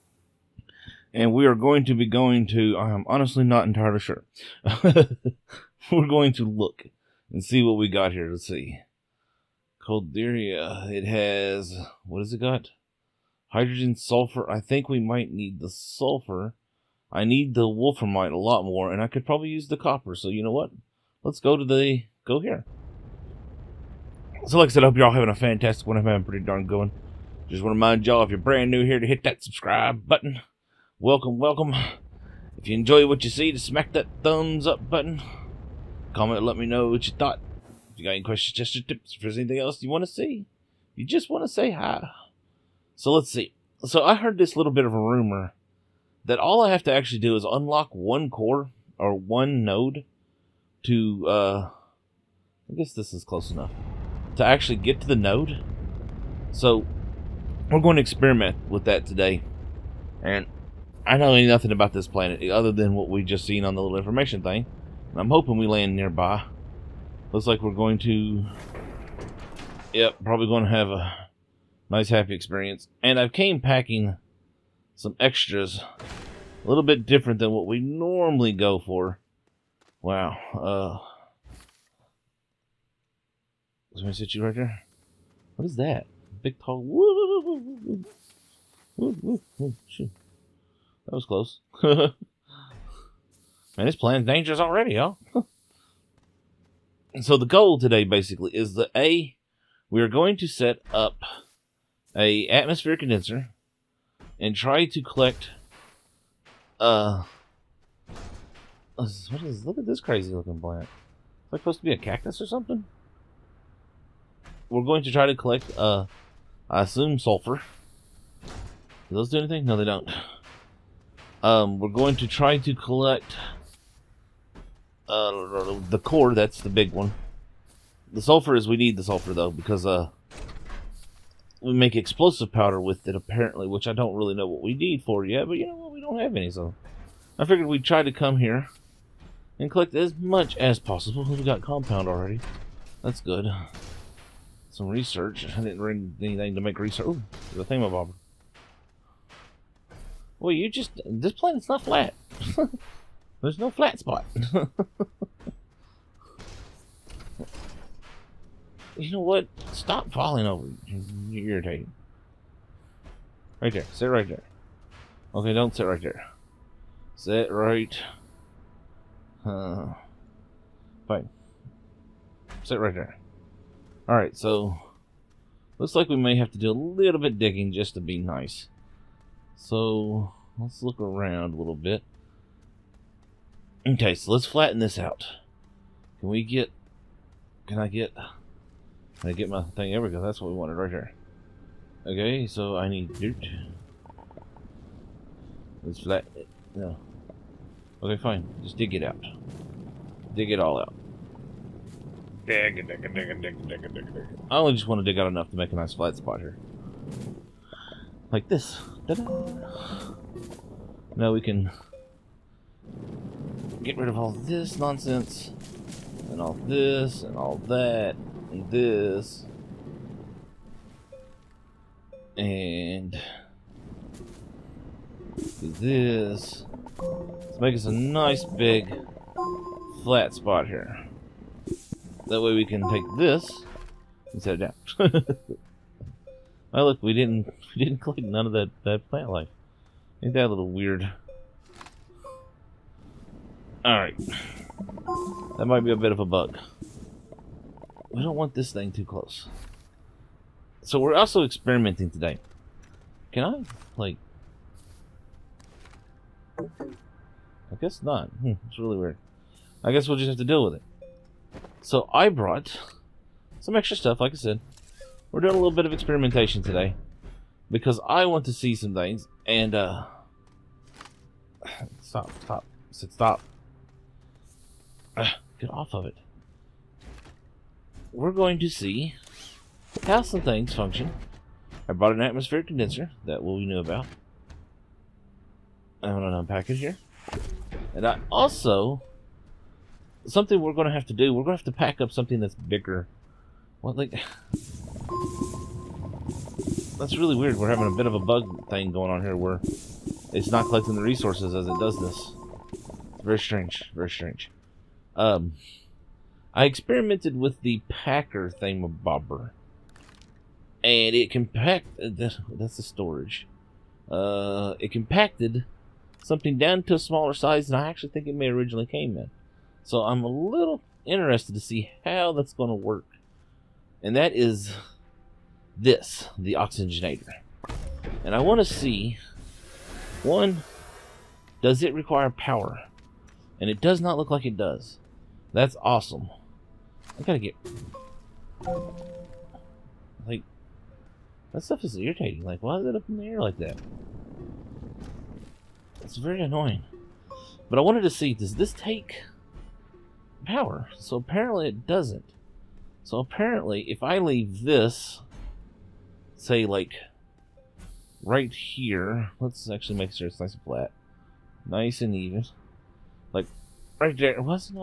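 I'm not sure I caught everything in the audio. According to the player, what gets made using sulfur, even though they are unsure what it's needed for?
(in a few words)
explosive powder.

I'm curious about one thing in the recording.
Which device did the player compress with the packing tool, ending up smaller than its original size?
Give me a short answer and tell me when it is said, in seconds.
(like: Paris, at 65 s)
the oxygenator, at 326 s.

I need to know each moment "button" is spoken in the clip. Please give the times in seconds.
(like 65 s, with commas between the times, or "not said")
30 s, 34 s.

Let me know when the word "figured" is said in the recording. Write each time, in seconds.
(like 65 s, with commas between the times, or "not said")
137 s.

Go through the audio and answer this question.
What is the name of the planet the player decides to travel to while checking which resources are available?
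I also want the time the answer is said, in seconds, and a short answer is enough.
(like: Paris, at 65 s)
Calidor, at 9 s.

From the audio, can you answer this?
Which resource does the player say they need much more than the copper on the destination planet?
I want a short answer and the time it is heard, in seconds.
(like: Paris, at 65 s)
wolframite, at 17 s.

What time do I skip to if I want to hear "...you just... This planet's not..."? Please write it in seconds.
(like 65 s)
150 s.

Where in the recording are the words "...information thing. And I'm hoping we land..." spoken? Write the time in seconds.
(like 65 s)
63 s.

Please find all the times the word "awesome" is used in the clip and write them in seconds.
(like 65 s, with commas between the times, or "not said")
335 s.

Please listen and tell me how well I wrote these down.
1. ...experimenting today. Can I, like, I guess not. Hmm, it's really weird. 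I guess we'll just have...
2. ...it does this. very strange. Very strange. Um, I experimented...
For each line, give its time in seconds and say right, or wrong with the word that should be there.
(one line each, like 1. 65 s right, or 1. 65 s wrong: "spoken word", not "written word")
1. 251 s right
2. 301 s right.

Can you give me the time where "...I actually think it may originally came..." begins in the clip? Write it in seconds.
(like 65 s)
317 s.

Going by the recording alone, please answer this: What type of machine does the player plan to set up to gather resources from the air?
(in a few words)
atmosphere condenser.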